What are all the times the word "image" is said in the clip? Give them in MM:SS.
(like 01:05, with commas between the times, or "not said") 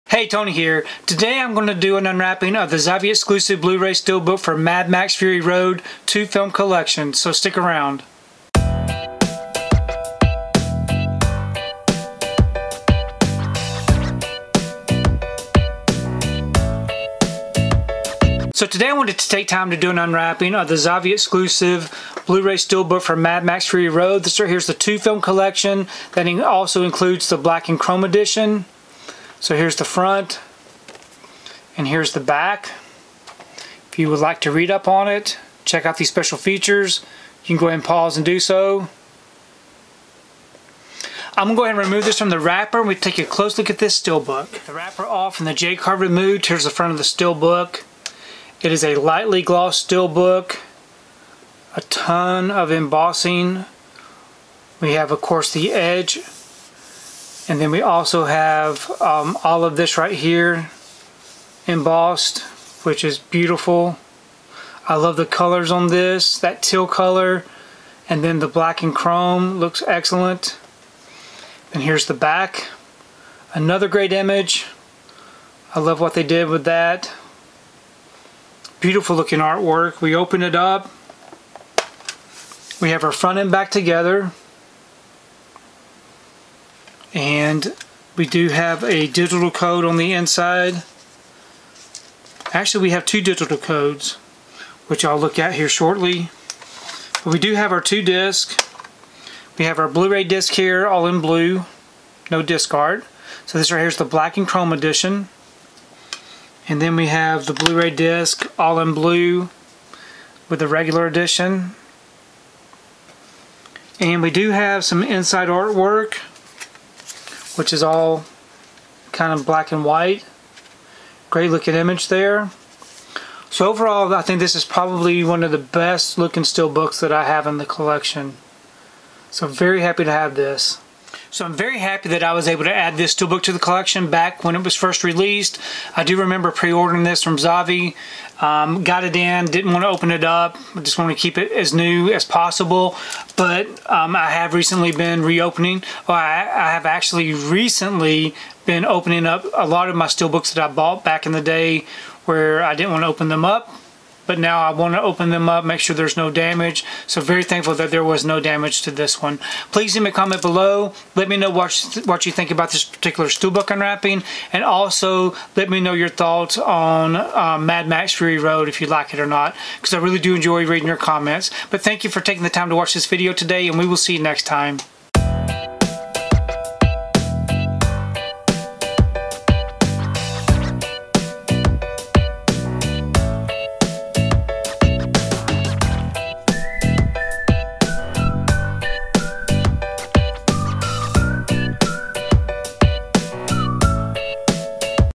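01:14, 02:01.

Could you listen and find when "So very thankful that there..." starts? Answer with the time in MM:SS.
02:37.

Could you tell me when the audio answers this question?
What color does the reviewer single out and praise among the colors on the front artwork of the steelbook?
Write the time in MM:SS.
01:06.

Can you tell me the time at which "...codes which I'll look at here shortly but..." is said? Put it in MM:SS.
01:33.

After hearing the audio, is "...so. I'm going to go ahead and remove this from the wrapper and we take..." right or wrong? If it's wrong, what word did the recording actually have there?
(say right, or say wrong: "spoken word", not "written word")
right.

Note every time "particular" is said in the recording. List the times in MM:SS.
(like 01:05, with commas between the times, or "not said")
02:42.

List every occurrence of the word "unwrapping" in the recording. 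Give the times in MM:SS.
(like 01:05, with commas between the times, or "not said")
00:02, 00:19, 02:43.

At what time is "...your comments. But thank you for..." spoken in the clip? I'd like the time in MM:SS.
02:50.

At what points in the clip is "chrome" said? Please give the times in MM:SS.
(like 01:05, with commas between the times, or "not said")
00:27, 01:08, 01:44.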